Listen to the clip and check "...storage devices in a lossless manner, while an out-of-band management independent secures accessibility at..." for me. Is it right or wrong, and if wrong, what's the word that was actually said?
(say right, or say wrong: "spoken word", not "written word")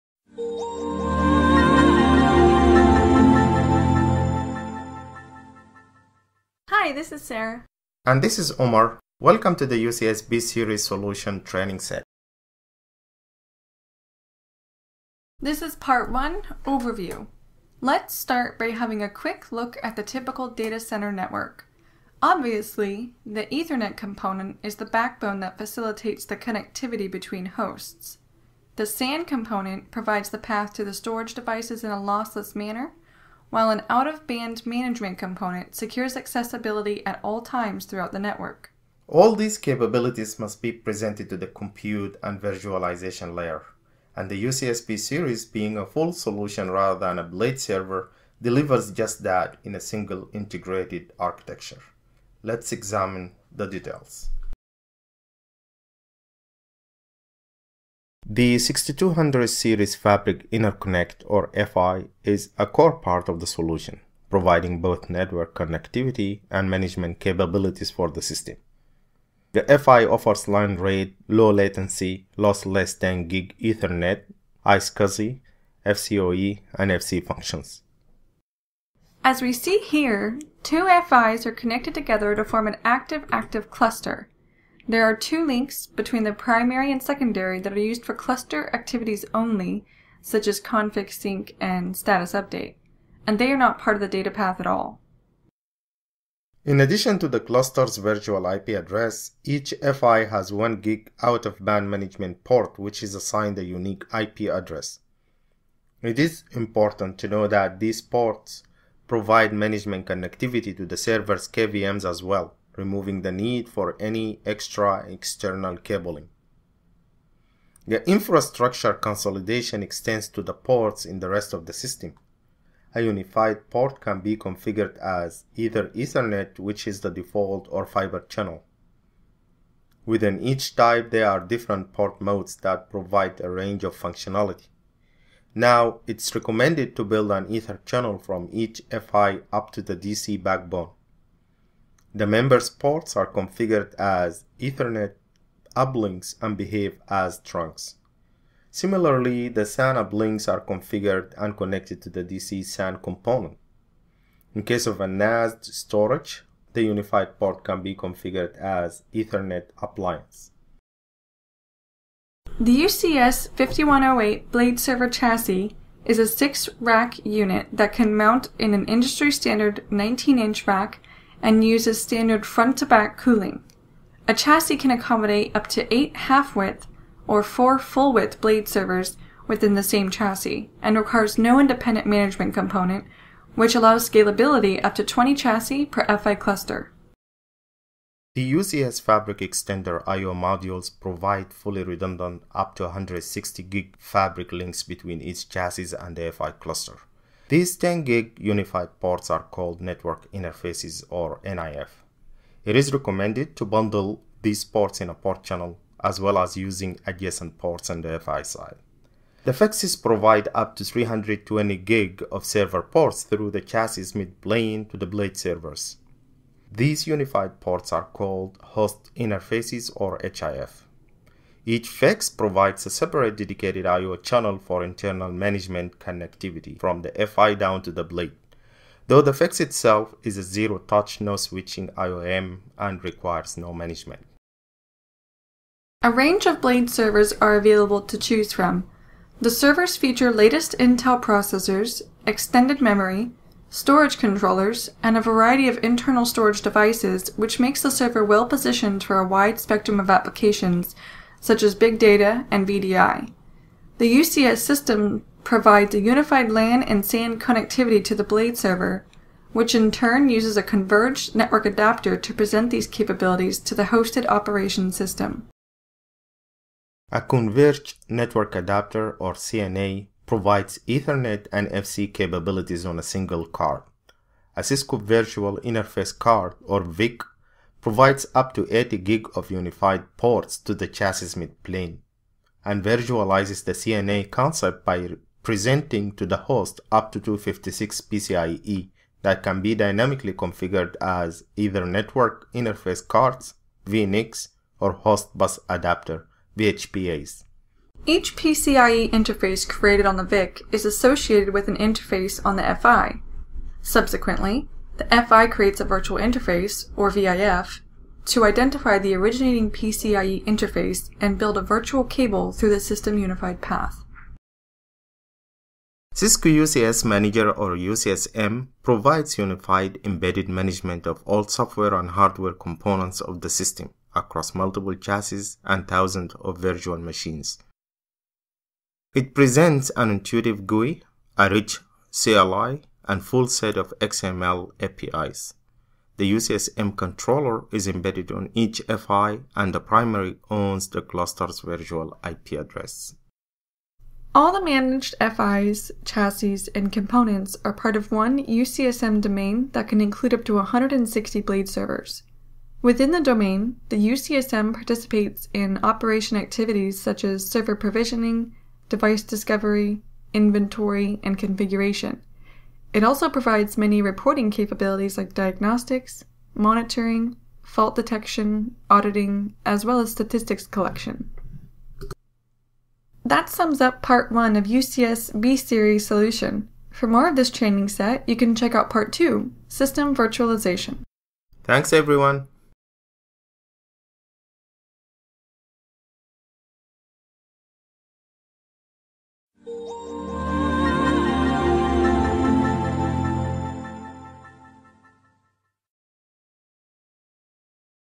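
wrong: "component", not "independent".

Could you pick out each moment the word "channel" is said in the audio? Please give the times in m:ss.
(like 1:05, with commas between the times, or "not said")
2:08, 2:17, 3:25, 3:44.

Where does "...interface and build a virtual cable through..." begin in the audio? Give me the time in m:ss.
5:10.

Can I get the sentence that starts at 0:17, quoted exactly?
Let's start by having a quick look at the typical data center network.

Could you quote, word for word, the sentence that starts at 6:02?
It also provides many reporting capabilities like diagnostics, monitoring, fault detection, auditing, as well as statistics collection.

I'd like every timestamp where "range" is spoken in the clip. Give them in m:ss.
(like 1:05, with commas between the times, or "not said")
2:13, 3:56.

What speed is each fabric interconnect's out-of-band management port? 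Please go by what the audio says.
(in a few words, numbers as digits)
1 gig.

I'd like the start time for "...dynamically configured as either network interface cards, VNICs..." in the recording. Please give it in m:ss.
4:49.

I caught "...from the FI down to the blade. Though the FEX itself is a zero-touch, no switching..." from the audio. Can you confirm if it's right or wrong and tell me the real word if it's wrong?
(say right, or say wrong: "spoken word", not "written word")
right.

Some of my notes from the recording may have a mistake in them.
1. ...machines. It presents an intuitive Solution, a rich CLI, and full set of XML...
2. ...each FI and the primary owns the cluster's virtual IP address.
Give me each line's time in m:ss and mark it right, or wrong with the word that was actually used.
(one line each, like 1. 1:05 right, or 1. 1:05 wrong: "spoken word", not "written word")
1. 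5:26 wrong: "GUI", not "Solution"
2. 5:38 right.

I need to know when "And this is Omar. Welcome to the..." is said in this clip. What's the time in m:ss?
0:08.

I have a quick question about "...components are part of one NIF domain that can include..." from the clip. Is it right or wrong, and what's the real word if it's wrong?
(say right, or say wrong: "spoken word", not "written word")
wrong: "UCSM", not "NIF".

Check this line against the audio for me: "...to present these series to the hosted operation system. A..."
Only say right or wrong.
wrong.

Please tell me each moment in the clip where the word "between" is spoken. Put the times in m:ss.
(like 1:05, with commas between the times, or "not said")
0:27, 1:25, 3:14.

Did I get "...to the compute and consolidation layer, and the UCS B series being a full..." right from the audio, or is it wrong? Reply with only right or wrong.
wrong.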